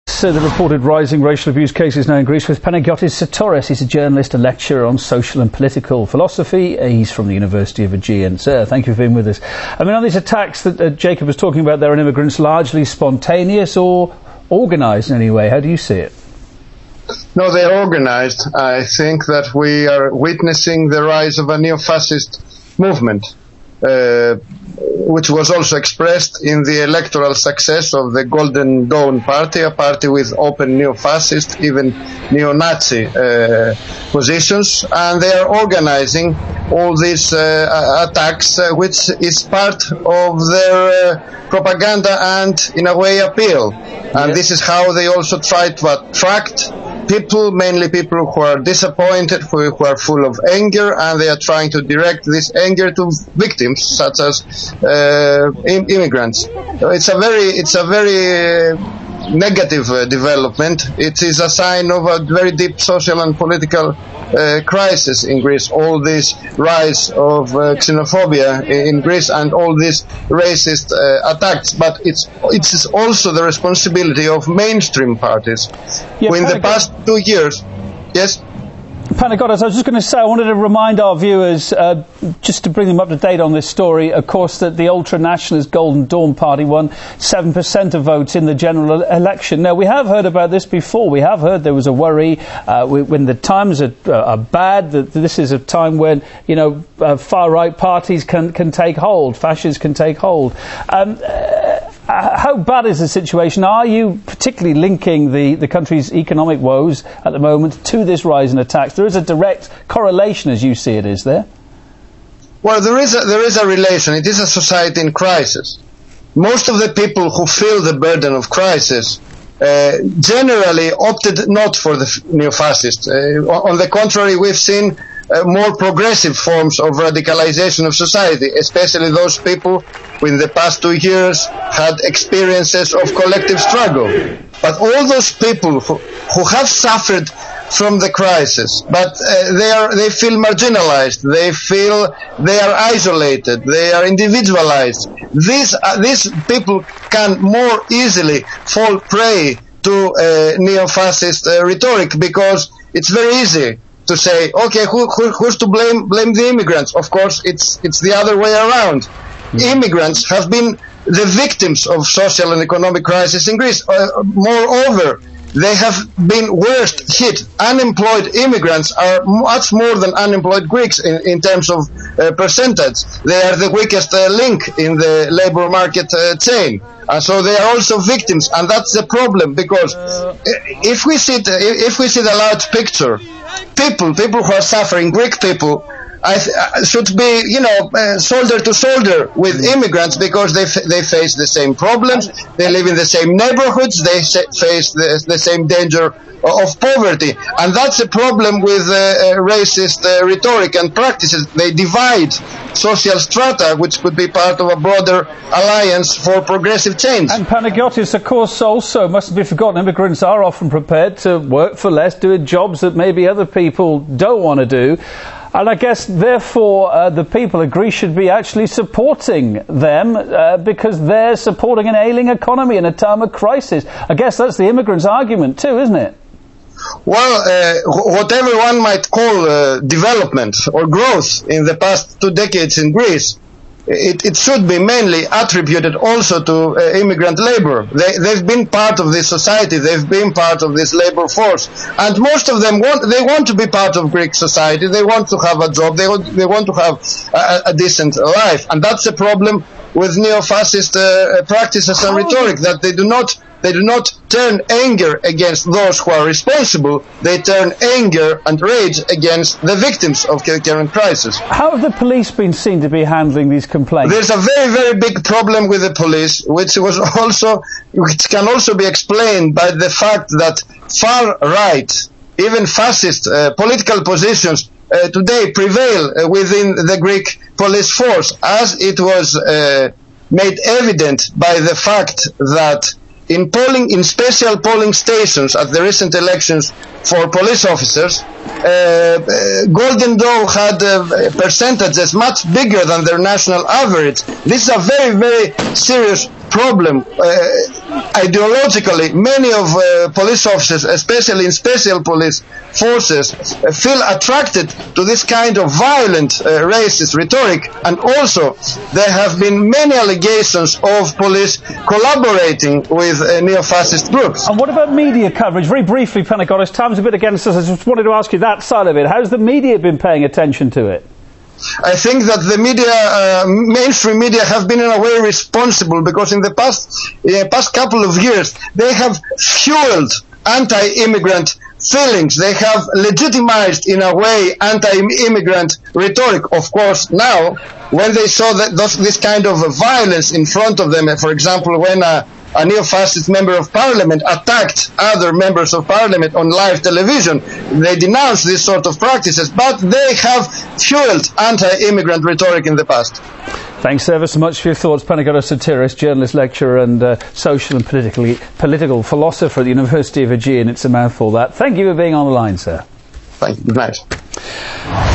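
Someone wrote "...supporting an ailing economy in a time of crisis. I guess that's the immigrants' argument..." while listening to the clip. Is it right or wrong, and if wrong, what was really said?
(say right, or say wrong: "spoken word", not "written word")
right.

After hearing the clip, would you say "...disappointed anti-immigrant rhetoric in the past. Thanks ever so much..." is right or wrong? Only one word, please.
wrong.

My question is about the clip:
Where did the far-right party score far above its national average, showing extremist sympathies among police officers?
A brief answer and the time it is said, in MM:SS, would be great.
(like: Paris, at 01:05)
special polling stations, at 04:44.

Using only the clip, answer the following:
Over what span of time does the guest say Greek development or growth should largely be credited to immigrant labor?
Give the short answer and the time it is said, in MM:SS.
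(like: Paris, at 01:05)
past two decades, at 03:51.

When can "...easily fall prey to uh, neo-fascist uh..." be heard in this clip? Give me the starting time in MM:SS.
02:27.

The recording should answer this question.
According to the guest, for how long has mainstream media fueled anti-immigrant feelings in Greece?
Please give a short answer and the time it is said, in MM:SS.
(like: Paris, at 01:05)
past couple of years, at 05:26.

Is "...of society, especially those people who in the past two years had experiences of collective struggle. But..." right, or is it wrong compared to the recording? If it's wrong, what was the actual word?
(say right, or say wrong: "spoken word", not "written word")
right.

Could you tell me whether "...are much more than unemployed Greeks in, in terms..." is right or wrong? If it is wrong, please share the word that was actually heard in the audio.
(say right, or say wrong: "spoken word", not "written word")
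right.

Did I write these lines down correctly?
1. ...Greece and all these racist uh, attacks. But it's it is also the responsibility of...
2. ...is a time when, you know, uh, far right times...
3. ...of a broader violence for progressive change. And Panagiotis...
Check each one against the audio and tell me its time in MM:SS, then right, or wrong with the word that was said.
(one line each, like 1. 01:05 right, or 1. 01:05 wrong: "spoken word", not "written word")
1. 01:09 right
2. 01:35 wrong: "parties", not "times"
3. 03:24 wrong: "alliance", not "violence".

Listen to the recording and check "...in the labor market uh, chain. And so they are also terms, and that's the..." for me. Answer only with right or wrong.
wrong.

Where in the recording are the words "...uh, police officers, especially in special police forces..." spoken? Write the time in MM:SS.
04:59.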